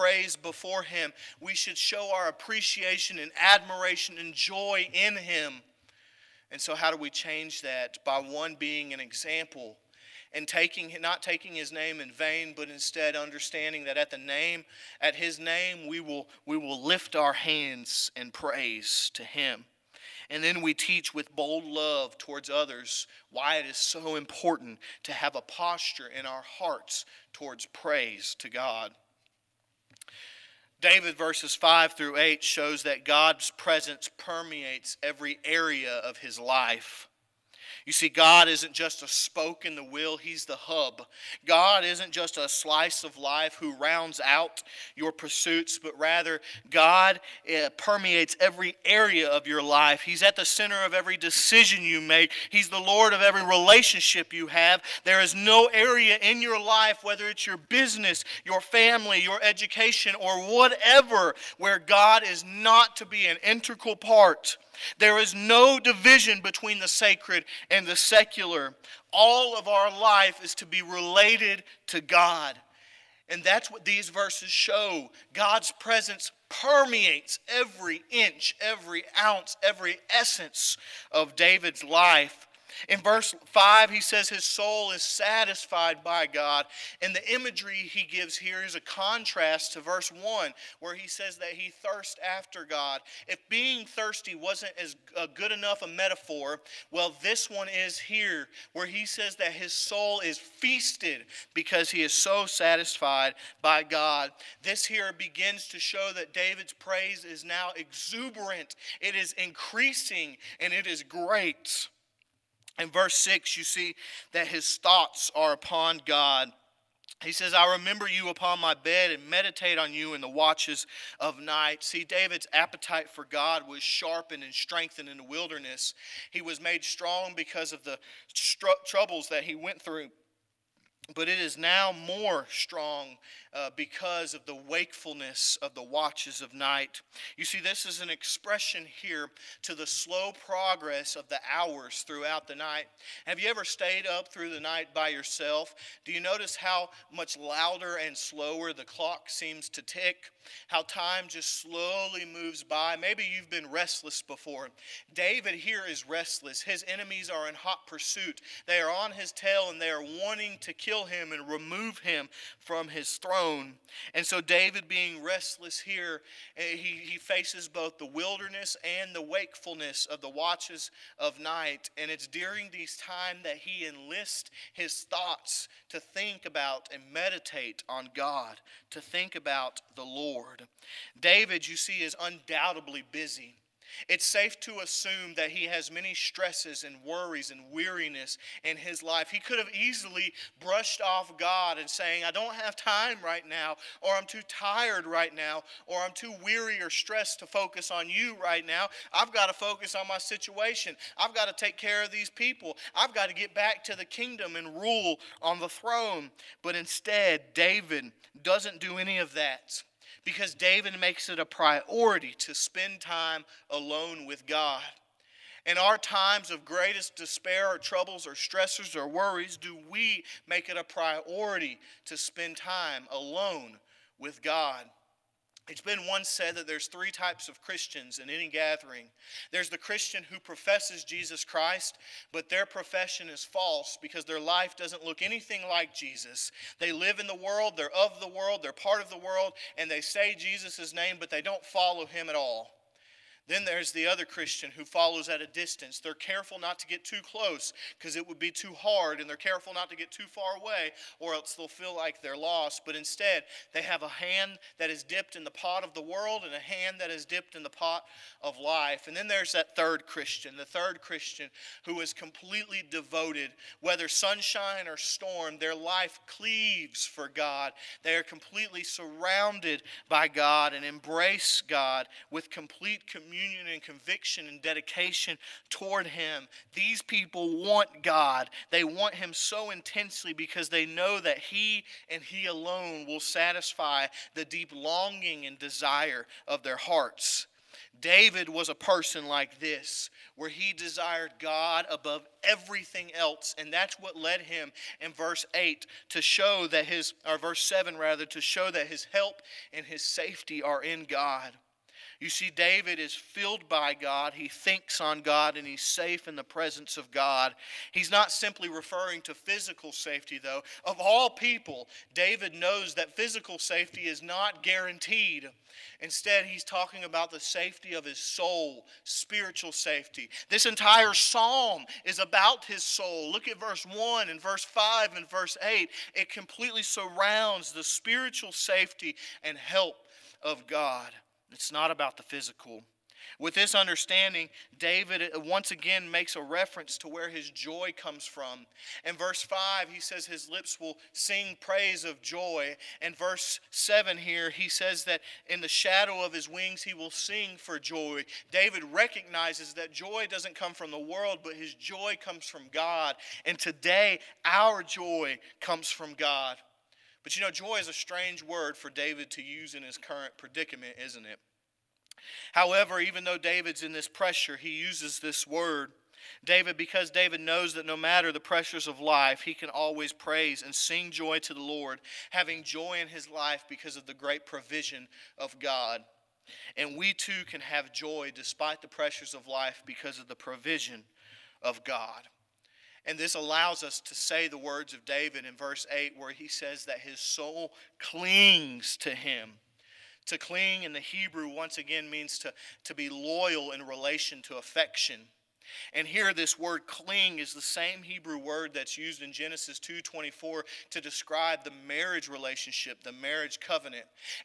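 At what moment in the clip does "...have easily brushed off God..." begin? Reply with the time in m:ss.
3:09.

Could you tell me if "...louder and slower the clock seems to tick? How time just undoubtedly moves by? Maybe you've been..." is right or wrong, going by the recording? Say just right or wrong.
wrong.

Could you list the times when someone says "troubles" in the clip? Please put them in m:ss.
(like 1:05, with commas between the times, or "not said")
2:08, 3:37.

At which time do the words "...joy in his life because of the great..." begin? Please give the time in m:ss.
6:12.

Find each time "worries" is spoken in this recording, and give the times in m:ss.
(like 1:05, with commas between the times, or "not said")
3:07, 3:39.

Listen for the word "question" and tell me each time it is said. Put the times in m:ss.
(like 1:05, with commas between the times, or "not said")
not said.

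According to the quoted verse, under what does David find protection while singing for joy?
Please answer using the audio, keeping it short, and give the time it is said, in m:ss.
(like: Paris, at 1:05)
The shadow of his wings, at 5:45.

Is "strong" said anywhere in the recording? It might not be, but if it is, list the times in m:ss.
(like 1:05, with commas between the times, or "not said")
2:06, 2:12.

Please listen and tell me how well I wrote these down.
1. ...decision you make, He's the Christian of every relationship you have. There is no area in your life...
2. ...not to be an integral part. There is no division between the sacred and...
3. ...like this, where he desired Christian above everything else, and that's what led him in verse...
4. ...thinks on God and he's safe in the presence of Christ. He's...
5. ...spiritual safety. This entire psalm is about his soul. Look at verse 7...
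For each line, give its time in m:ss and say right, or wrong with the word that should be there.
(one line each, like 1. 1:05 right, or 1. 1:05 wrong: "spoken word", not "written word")
1. 0:51 wrong: "Lord", not "Christian"
2. 1:02 right
3. 4:49 wrong: "God", not "Christian"
4. 5:04 wrong: "God", not "Christ"
5. 5:19 wrong: "1", not "7".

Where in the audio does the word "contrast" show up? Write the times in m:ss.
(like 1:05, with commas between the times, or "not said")
1:28.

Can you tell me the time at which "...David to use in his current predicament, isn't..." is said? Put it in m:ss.
5:58.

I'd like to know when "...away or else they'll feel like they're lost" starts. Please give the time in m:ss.
4:10.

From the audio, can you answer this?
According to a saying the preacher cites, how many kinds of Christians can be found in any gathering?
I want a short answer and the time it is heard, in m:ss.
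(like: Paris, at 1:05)
3, at 3:46.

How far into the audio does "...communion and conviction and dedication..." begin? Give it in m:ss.
4:33.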